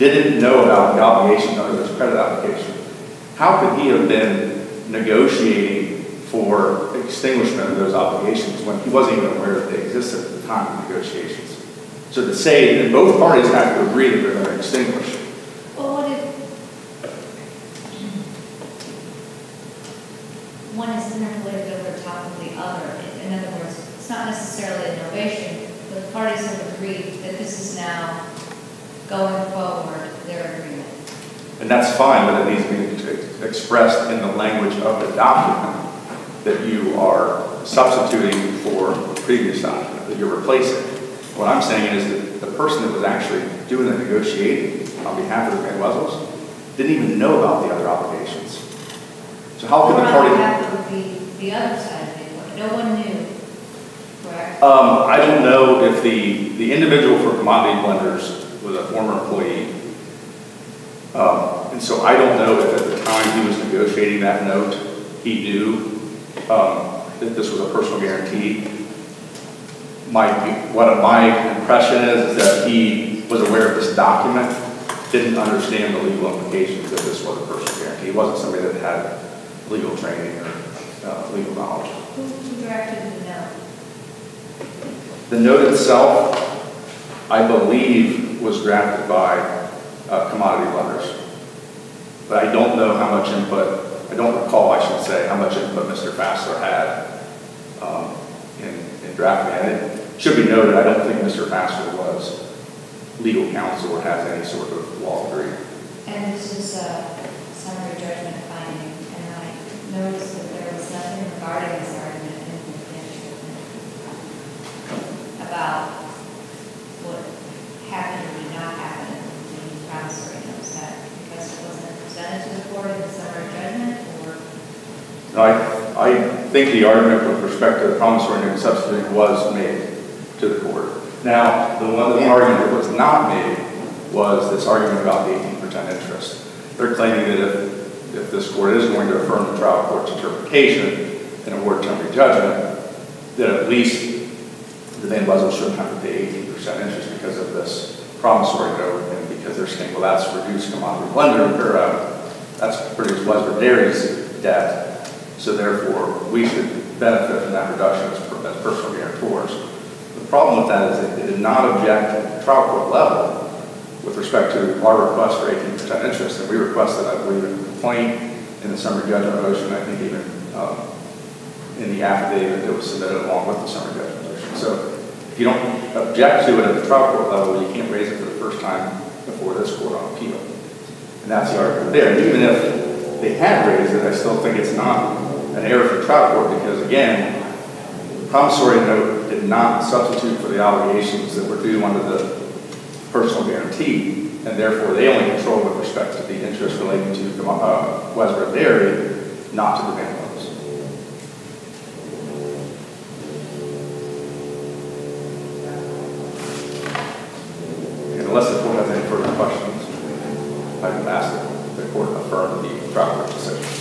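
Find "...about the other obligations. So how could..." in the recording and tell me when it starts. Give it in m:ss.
0:47.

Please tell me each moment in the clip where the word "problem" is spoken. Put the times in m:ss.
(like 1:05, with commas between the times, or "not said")
2:40.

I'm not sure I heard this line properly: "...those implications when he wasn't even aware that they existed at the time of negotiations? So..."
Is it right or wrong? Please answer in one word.
wrong.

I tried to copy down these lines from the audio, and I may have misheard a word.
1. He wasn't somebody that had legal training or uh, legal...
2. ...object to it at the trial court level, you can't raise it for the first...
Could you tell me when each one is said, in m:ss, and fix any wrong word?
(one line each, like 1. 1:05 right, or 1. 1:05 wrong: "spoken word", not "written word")
1. 1:18 right
2. 2:56 right.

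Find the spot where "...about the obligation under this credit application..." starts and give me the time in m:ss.
0:00.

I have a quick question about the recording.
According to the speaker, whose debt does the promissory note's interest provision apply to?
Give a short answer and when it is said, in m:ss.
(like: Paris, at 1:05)
Westbrook Dairy, at 3:18.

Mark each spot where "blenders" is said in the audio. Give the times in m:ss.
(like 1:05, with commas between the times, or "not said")
0:57, 1:30, 2:31.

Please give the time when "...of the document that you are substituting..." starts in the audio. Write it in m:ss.
0:34.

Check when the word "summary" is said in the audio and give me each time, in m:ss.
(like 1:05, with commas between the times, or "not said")
1:47, 2:48, 2:53.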